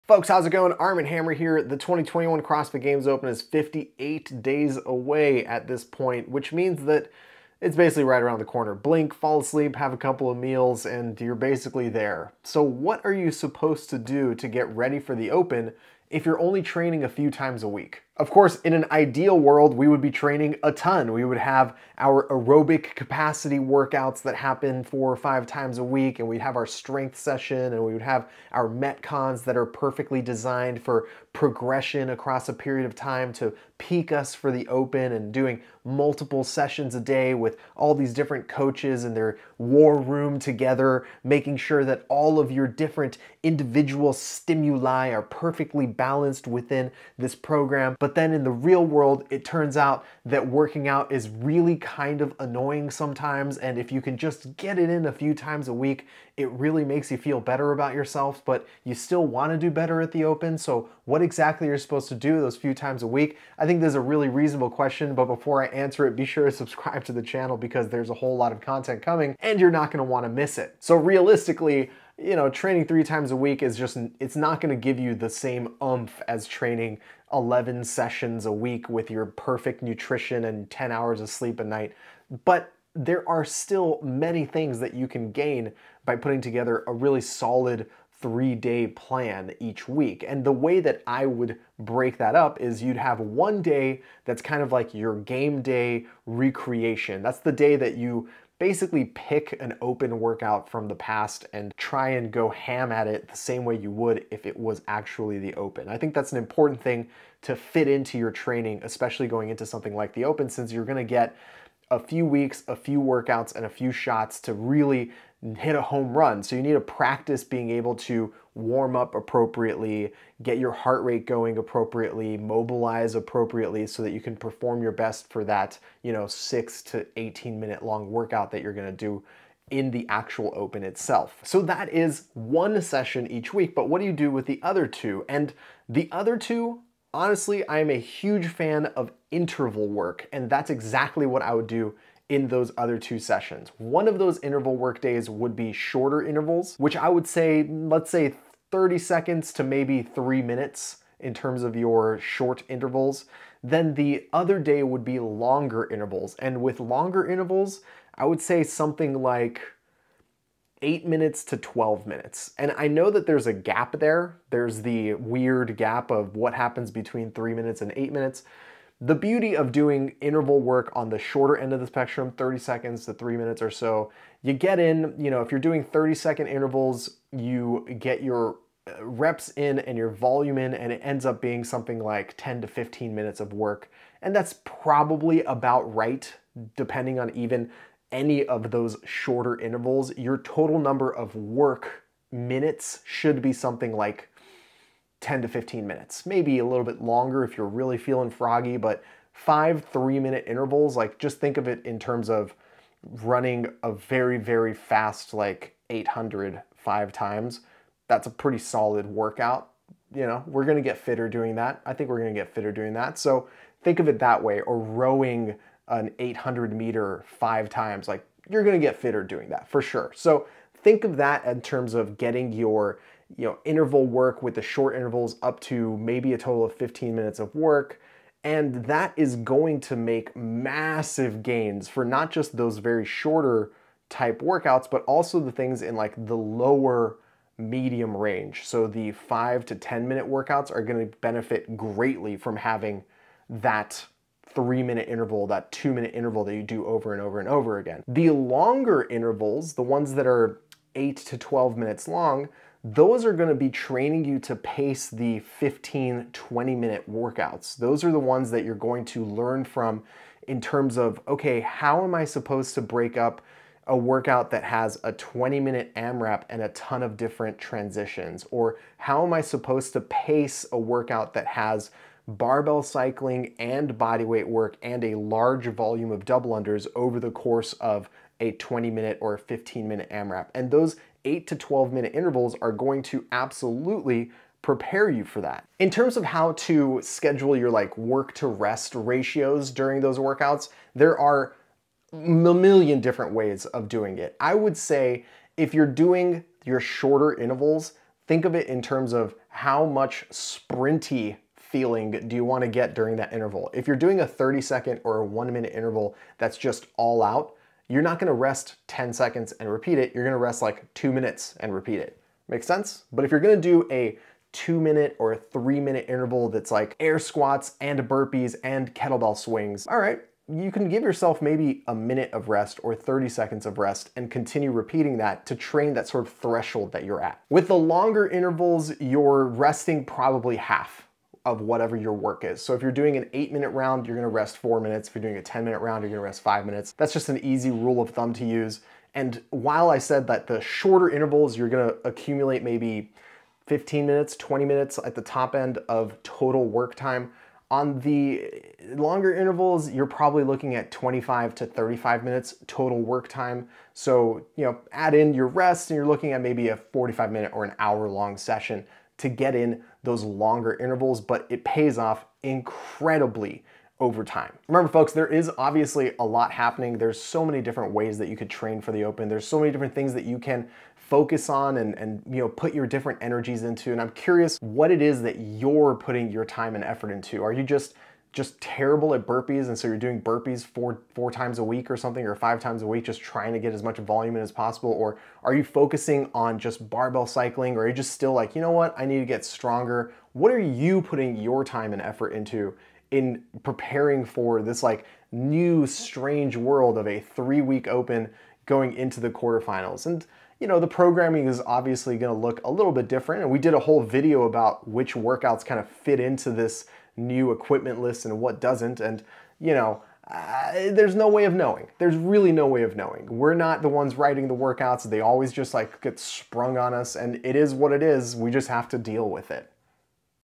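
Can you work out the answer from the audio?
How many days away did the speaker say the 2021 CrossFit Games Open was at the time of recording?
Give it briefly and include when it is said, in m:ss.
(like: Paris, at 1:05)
58, at 0:03.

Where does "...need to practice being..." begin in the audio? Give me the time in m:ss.
1:56.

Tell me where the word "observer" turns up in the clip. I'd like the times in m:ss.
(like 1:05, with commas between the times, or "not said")
not said.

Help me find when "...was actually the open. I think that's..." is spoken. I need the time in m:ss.
1:44.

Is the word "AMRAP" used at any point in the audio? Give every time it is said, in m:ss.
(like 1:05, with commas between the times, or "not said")
4:25, 4:40.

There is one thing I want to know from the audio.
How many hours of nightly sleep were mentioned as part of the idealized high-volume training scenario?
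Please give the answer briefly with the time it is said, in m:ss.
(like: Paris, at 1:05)
10, at 1:20.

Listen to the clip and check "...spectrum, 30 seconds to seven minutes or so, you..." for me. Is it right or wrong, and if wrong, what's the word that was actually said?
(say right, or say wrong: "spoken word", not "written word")
wrong: "three", not "seven".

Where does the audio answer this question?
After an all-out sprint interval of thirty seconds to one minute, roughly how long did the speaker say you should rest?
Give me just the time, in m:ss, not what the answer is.
5:10.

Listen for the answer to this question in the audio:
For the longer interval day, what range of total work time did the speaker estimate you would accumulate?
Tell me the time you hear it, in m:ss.
5:50.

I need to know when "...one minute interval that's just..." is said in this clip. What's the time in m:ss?
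5:05.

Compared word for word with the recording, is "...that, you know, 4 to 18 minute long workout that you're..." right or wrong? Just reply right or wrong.
wrong.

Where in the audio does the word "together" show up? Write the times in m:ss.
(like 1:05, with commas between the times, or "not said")
0:40, 1:26.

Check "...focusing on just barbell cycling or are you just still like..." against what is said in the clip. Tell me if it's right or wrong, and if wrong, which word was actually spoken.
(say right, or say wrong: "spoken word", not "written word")
right.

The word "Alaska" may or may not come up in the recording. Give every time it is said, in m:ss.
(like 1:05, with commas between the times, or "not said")
not said.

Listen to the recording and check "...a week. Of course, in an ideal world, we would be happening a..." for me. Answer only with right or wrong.
wrong.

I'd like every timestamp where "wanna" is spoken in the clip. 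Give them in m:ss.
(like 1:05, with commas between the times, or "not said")
0:59, 1:10.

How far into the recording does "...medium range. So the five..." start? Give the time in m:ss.
3:57.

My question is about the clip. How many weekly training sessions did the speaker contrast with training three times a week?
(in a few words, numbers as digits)
11.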